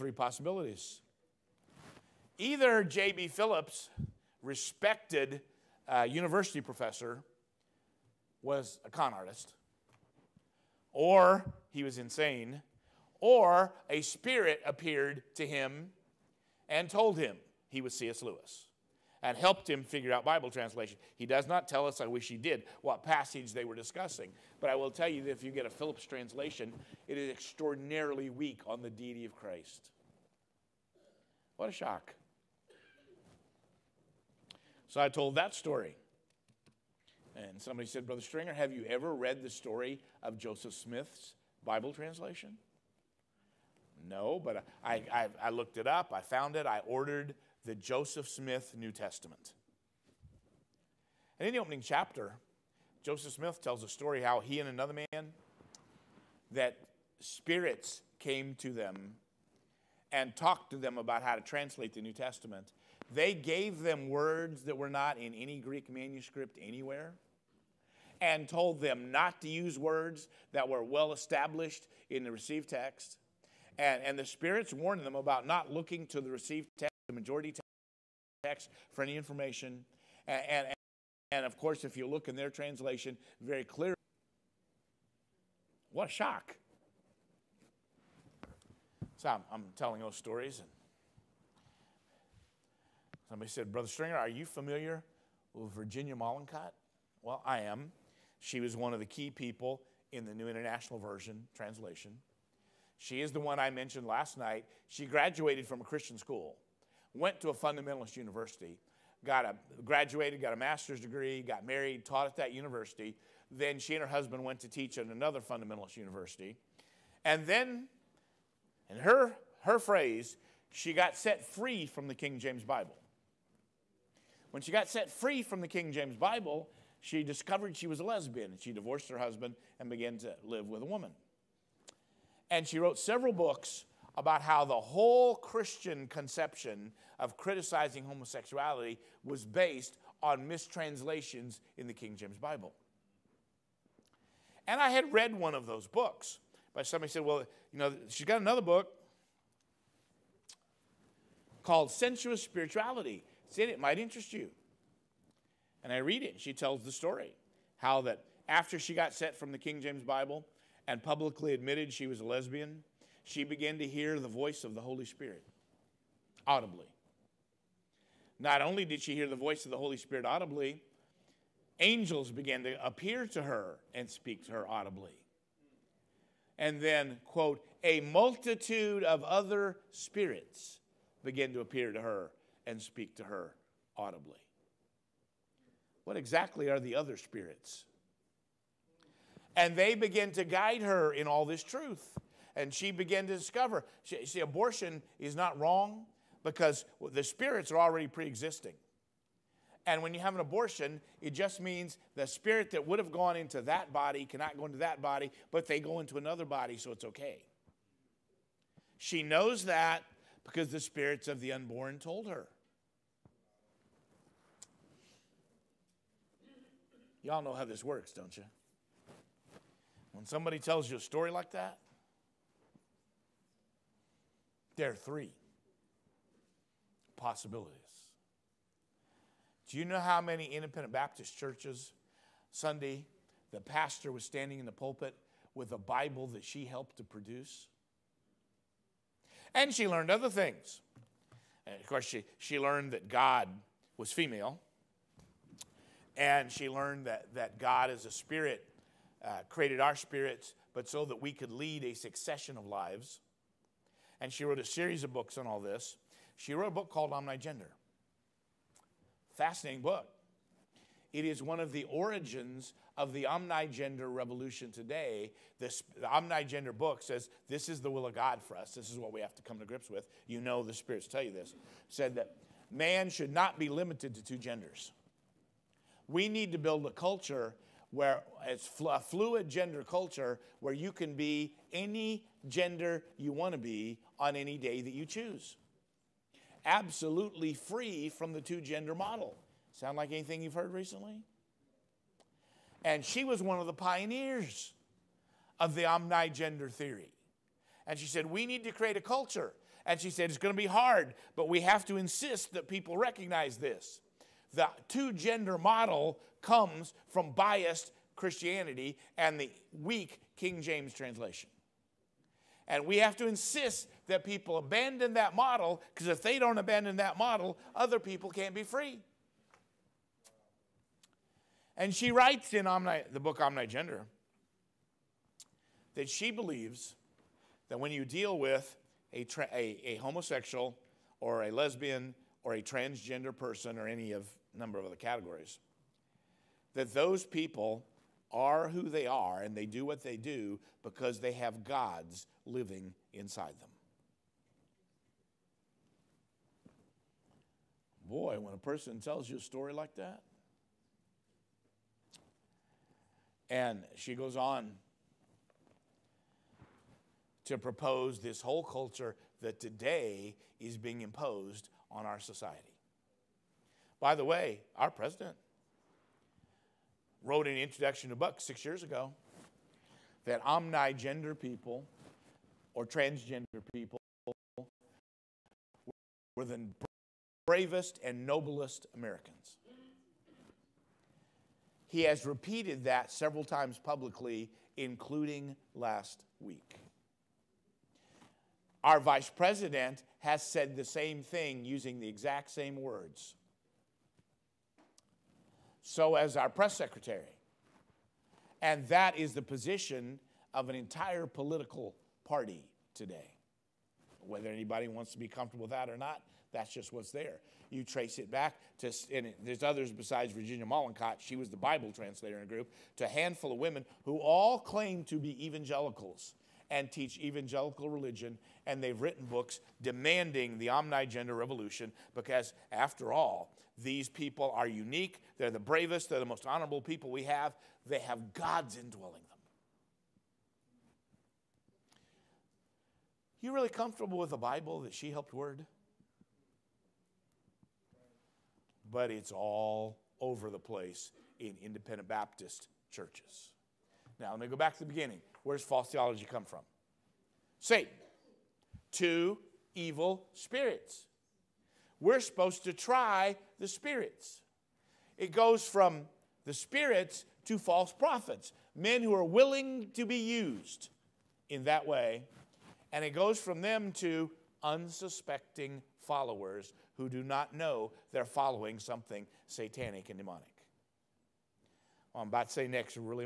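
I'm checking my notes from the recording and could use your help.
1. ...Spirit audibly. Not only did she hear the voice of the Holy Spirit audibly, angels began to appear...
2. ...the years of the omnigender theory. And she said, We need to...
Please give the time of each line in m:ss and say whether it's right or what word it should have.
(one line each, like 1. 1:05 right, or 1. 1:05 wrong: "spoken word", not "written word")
1. 2:45 right
2. 4:53 wrong: "pioneers", not "years".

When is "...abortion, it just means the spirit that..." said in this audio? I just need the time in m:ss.
3:20.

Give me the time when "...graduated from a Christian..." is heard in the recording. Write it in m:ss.
1:45.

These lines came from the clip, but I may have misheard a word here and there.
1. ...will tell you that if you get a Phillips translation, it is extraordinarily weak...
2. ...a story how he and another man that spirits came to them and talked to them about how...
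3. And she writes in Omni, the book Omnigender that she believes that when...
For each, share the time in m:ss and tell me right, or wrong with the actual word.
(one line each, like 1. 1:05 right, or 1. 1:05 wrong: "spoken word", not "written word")
1. 0:24 right
2. 0:53 right
3. 5:21 right.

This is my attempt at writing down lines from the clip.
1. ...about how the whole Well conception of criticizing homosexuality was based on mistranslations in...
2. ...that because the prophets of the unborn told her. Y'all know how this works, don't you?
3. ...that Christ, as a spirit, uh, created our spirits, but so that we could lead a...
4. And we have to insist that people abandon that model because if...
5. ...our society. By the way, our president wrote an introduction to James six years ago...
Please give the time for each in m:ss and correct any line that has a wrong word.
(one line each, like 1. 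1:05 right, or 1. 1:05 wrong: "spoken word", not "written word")
1. 2:14 wrong: "Christian", not "Well"
2. 3:29 wrong: "spirits", not "prophets"
3. 4:07 wrong: "God", not "Christ"
4. 5:12 right
5. 6:02 wrong: "Buck", not "James".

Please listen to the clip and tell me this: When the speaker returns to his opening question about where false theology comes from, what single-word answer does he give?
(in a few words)
Satan.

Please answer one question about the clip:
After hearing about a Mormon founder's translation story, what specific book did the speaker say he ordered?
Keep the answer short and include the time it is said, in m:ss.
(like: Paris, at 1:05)
Joseph Smith New Testament, at 0:47.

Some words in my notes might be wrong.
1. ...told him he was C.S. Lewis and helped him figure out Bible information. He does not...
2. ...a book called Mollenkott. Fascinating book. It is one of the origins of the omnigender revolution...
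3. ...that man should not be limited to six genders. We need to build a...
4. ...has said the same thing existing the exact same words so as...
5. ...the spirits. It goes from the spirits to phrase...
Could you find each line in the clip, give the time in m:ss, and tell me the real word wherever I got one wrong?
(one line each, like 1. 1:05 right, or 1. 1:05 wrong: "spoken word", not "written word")
1. 0:16 wrong: "translation", not "information"
2. 4:16 wrong: "Omnigender", not "Mollenkott"
3. 4:32 wrong: "two", not "six"
4. 6:30 wrong: "using", not "existing"
5. 7:33 wrong: "false", not "phrase".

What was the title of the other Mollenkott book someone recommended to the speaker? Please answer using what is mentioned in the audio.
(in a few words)
Sensuous Spirituality.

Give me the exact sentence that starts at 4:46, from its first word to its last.
Absolutely free from the two gender model.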